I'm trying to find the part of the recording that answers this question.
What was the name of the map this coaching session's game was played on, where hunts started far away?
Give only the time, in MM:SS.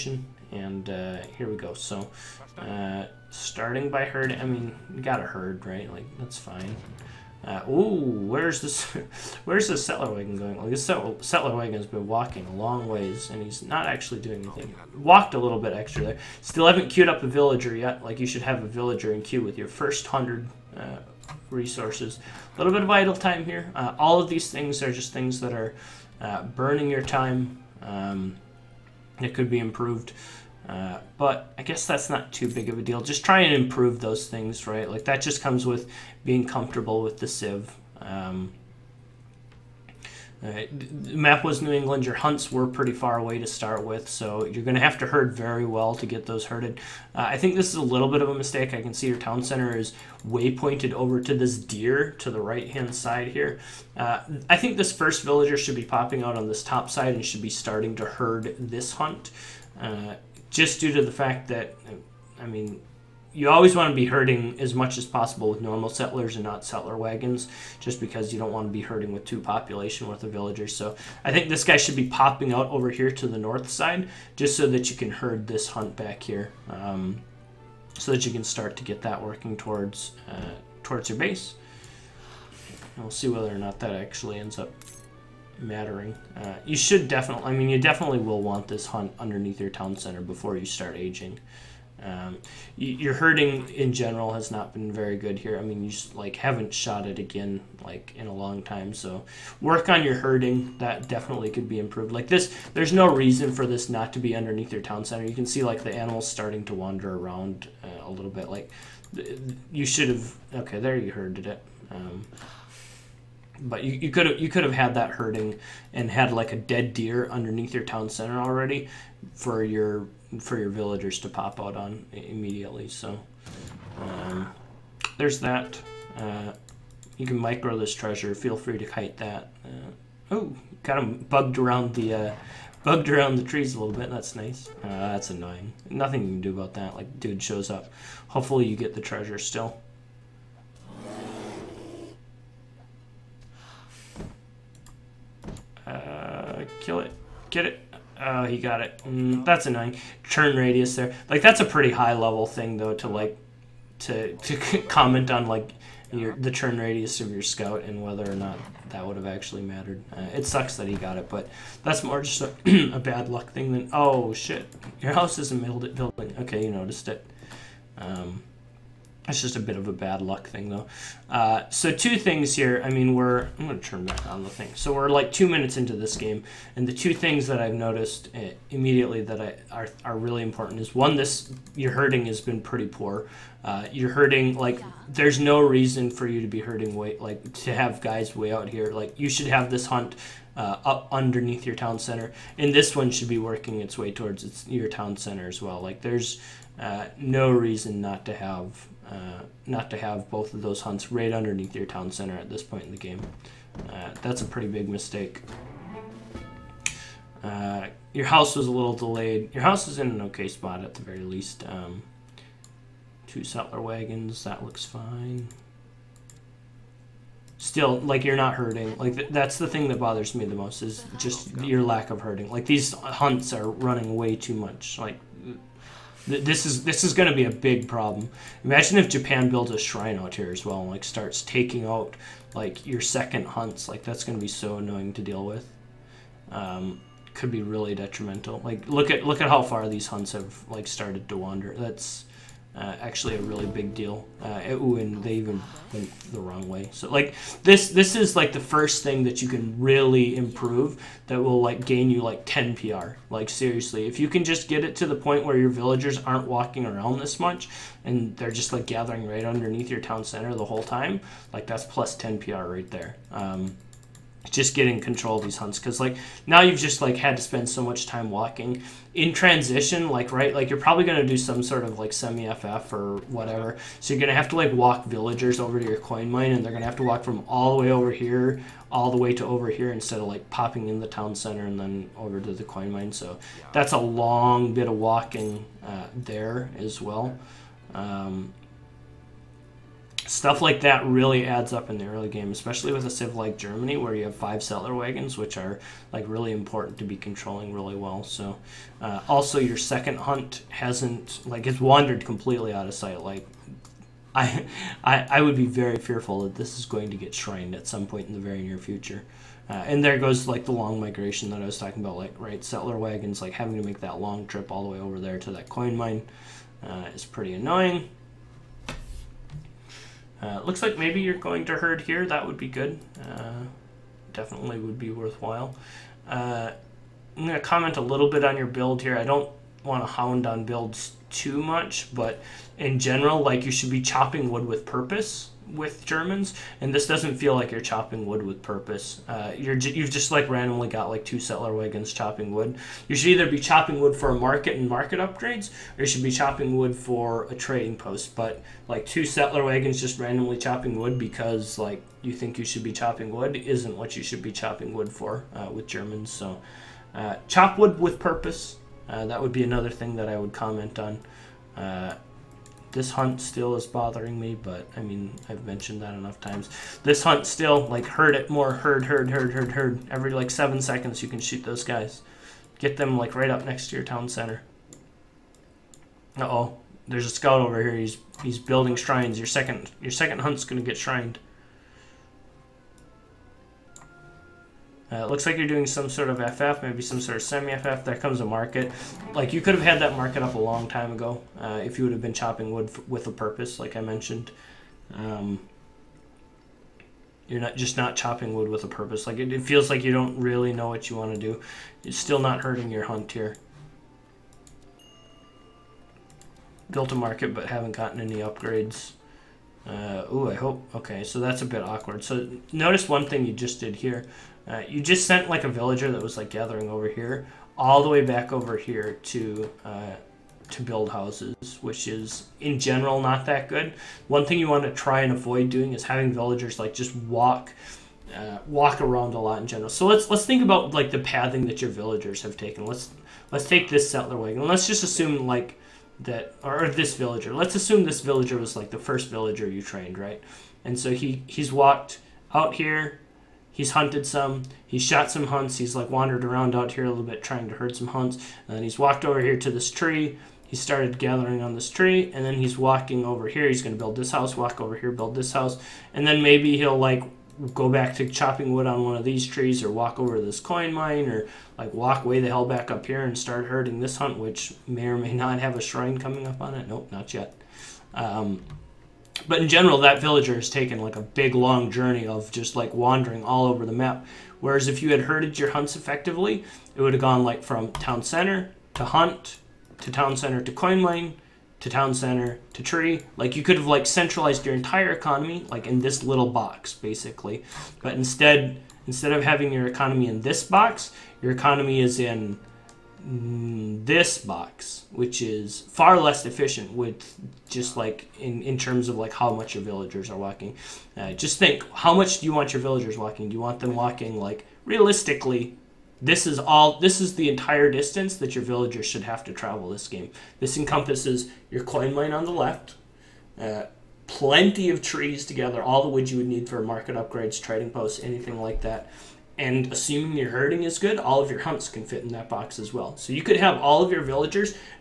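00:41.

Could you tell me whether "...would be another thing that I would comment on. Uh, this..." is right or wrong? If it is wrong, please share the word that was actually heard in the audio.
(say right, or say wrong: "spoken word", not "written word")
right.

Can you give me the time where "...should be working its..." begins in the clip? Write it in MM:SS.
03:13.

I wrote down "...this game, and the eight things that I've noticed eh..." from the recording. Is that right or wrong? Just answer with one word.
wrong.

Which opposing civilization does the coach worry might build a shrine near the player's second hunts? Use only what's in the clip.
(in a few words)
Japan.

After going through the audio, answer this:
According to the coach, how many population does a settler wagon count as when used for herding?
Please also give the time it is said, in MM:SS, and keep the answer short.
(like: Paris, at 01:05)
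2, at 01:09.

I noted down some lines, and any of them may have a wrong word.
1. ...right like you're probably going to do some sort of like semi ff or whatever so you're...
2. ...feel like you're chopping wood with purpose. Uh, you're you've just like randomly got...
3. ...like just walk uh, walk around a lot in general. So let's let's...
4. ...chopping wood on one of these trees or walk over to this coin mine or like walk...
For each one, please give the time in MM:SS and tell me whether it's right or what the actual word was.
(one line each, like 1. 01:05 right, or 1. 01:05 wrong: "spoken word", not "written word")
1. 04:30 right
2. 05:37 right
3. 07:06 right
4. 07:38 right.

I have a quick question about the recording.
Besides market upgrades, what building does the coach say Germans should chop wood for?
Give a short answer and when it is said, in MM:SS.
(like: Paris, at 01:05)
trading post, at 05:47.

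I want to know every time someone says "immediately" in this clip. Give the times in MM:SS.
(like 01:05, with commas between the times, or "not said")
02:02, 02:58.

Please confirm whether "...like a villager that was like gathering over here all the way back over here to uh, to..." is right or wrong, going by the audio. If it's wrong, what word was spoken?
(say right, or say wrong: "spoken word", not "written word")
right.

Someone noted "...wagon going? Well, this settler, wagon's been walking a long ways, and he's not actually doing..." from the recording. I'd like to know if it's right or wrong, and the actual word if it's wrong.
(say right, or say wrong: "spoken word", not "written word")
right.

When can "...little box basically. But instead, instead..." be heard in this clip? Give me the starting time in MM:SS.
08:06.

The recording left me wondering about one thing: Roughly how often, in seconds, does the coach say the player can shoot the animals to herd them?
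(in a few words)
7.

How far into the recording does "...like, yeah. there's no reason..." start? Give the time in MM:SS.
03:04.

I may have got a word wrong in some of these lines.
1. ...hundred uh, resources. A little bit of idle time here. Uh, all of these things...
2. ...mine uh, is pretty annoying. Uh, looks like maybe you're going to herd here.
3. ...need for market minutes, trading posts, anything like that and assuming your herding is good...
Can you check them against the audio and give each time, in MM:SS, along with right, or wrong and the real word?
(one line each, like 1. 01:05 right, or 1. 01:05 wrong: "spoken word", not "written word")
1. 00:20 right
2. 05:15 right
3. 08:36 wrong: "upgrades", not "minutes".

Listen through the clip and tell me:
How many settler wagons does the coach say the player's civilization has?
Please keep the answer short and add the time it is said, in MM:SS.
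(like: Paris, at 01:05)
5, at 04:54.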